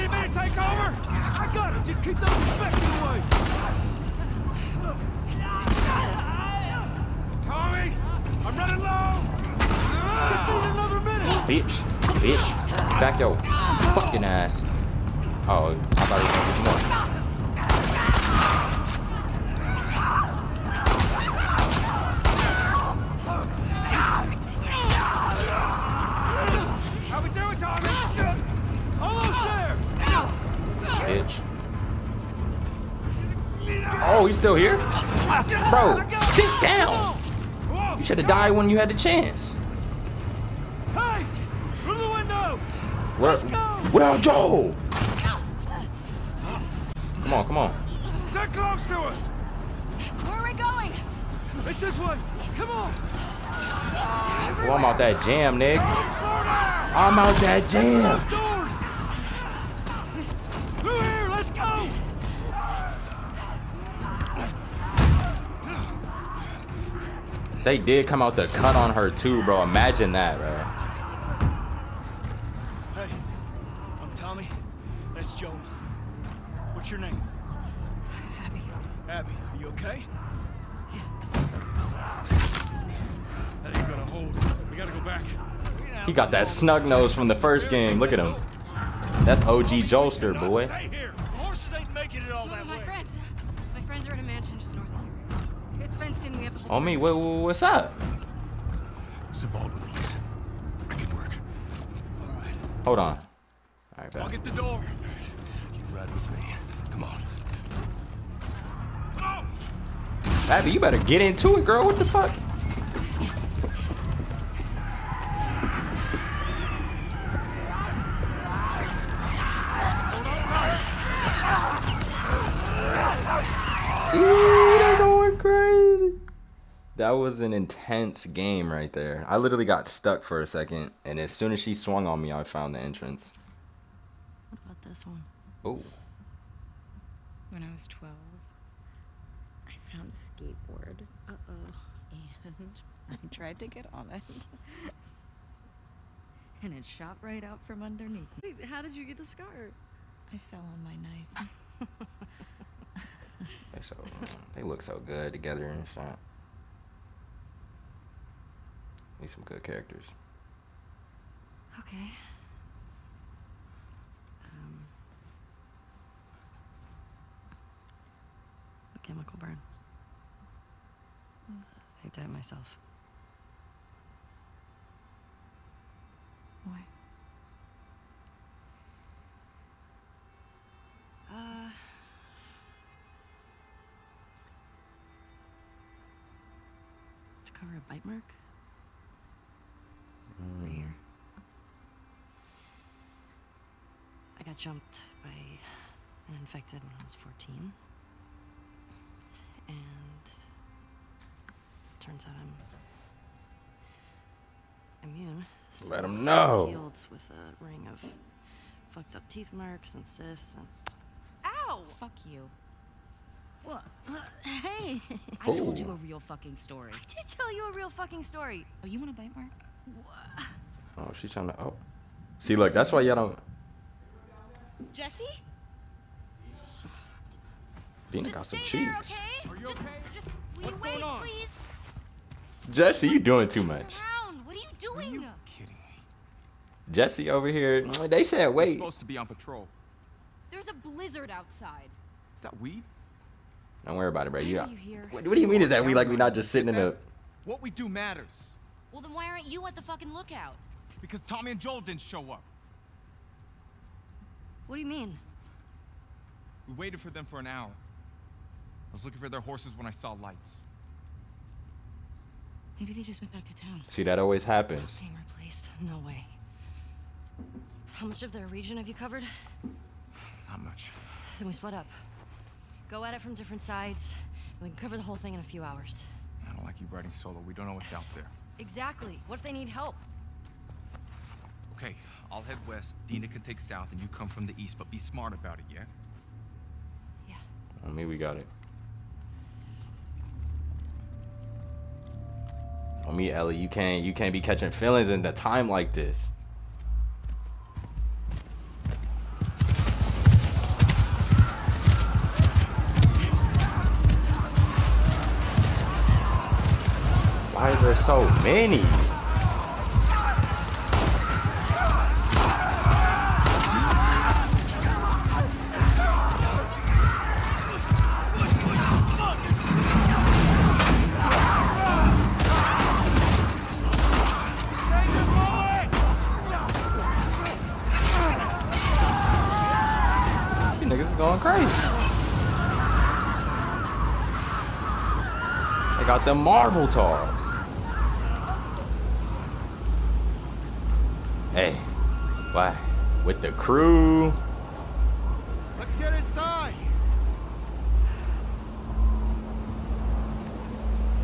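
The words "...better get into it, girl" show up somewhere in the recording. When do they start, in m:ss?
1:50.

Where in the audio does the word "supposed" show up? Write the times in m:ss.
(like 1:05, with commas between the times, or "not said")
3:58.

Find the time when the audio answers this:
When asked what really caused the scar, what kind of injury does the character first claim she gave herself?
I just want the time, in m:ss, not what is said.
2:48.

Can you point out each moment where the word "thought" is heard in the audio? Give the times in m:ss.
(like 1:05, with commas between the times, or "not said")
0:16.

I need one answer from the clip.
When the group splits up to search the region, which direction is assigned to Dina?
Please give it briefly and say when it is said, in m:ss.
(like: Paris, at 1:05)
south, at 4:43.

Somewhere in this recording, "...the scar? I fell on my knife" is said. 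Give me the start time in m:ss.
2:29.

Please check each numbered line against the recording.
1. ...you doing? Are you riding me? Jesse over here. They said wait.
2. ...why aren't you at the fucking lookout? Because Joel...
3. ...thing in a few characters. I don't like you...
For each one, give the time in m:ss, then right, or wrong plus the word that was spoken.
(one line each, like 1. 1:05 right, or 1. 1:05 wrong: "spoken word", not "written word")
1. 3:54 wrong: "kidding", not "riding"
2. 4:09 wrong: "Tommy", not "Joel"
3. 4:35 wrong: "hours", not "characters".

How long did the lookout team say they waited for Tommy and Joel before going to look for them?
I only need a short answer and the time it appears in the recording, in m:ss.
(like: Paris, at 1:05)
1 hour, at 4:17.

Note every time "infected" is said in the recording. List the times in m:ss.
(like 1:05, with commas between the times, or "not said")
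0:02, 3:16.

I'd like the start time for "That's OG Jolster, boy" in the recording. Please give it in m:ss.
1:29.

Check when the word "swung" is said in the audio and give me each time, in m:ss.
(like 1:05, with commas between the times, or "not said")
2:11.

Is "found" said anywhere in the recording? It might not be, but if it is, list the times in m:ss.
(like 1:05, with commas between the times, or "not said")
2:12, 2:19.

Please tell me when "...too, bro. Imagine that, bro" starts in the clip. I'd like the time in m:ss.
1:09.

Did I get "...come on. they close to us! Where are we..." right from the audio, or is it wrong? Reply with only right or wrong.
right.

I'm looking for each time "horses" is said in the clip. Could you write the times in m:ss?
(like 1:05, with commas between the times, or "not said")
4:19.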